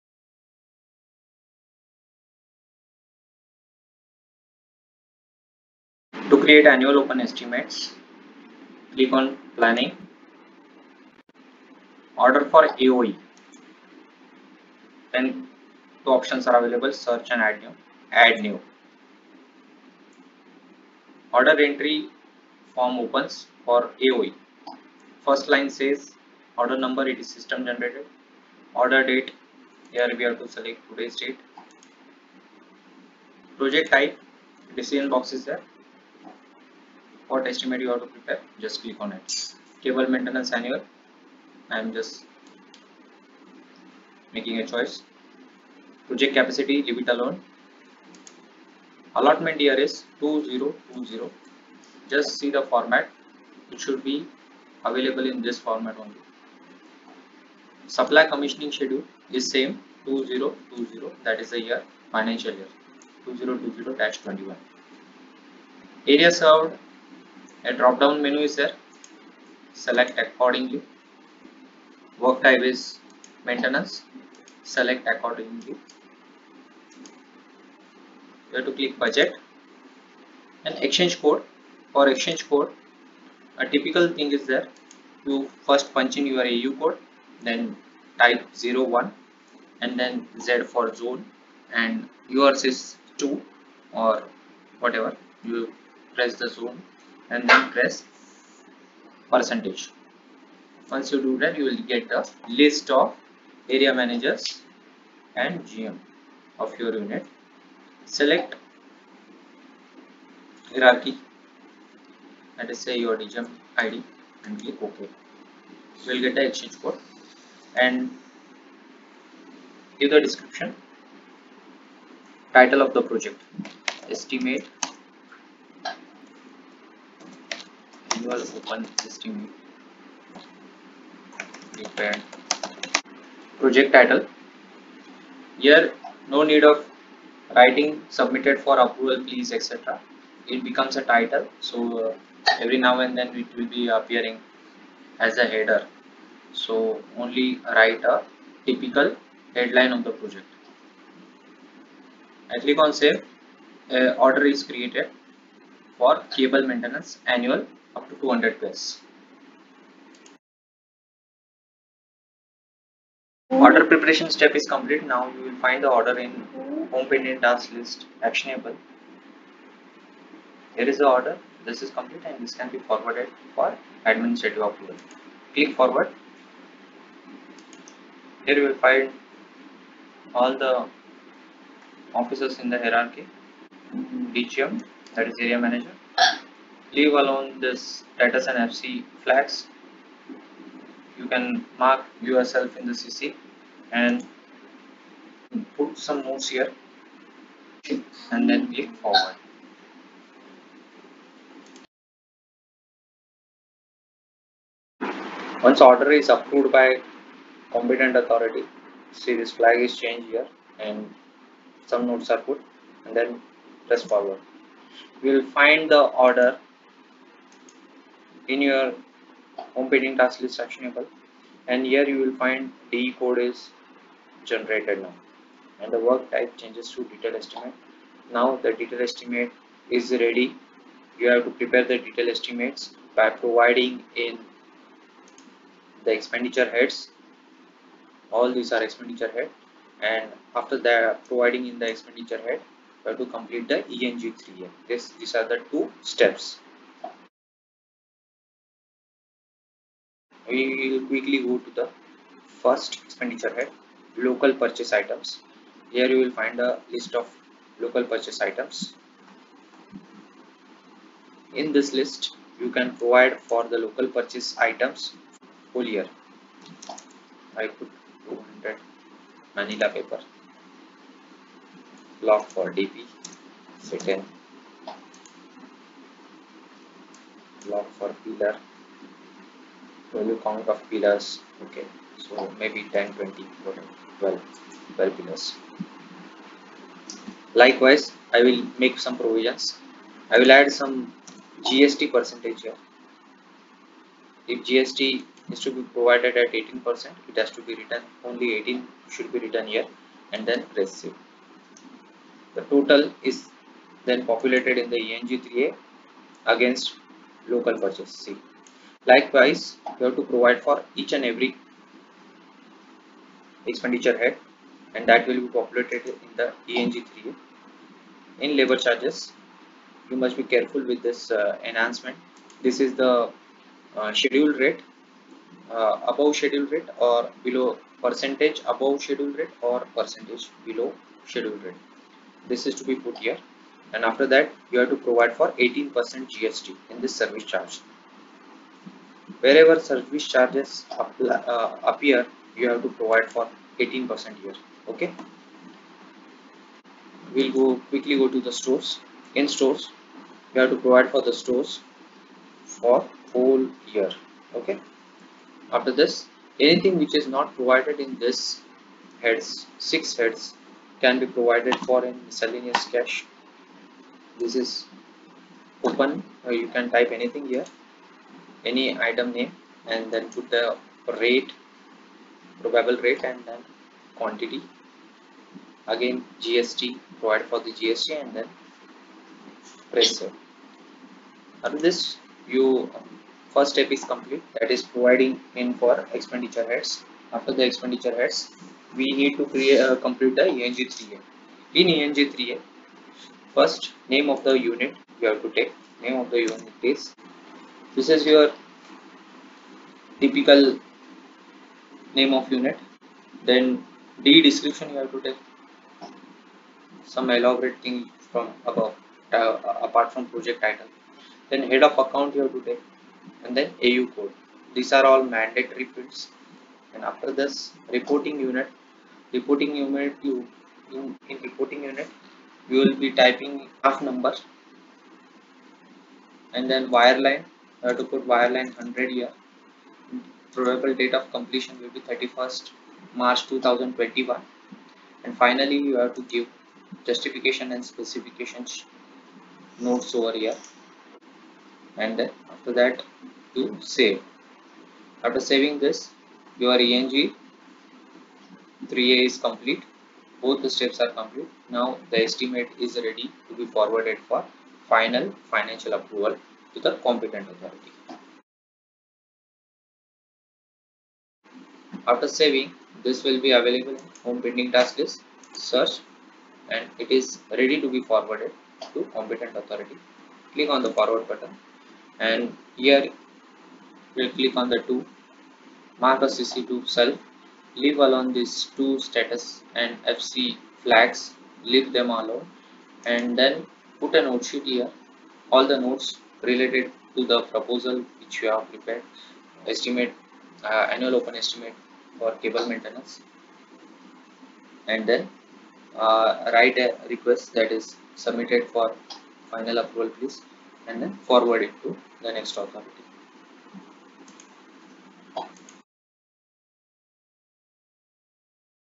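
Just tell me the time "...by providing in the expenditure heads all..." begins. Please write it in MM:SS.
03:53.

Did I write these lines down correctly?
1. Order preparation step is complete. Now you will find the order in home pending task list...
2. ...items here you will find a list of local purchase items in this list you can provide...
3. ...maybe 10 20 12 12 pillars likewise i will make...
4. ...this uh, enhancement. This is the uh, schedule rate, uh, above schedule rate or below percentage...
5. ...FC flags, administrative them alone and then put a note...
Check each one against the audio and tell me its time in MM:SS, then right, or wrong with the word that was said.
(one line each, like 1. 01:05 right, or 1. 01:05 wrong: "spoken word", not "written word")
1. 02:43 right
2. 04:14 right
3. 04:42 right
4. 05:21 right
5. 08:00 wrong: "leave", not "administrative".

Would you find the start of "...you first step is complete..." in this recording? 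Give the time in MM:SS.
06:22.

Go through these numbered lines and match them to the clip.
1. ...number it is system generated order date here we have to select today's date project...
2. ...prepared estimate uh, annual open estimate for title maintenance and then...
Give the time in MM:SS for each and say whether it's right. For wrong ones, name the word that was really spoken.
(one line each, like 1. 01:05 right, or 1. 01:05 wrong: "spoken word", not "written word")
1. 00:26 right
2. 08:08 wrong: "cable", not "title".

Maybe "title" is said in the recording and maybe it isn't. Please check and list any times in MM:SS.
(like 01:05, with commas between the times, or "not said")
02:02, 02:13, 02:21, 06:50.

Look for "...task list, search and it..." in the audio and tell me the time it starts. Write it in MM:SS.
07:44.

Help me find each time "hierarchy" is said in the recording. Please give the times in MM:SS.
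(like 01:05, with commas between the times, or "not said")
01:50, 03:02.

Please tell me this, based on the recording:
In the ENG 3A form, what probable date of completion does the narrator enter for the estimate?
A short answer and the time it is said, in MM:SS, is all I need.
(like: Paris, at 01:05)
31 March 2021, at 07:12.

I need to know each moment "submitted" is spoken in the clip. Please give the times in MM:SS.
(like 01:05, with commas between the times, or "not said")
02:18, 08:18.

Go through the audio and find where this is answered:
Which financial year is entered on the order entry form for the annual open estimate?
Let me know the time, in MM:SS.
01:03.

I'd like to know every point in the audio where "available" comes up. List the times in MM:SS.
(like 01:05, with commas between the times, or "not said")
00:16, 00:54, 07:43.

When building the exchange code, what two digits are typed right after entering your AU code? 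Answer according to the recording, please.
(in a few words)
01.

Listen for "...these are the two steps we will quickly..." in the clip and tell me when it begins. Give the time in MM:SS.
04:05.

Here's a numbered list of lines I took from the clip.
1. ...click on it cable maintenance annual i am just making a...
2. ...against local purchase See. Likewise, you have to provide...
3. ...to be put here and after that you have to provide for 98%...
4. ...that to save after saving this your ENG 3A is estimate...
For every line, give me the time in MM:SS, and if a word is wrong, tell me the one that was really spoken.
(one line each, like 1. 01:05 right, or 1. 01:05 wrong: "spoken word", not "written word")
1. 00:38 right
2. 05:06 right
3. 05:32 wrong: "18", not "98"
4. 07:22 wrong: "complete", not "estimate".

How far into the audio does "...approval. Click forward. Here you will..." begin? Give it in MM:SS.
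02:54.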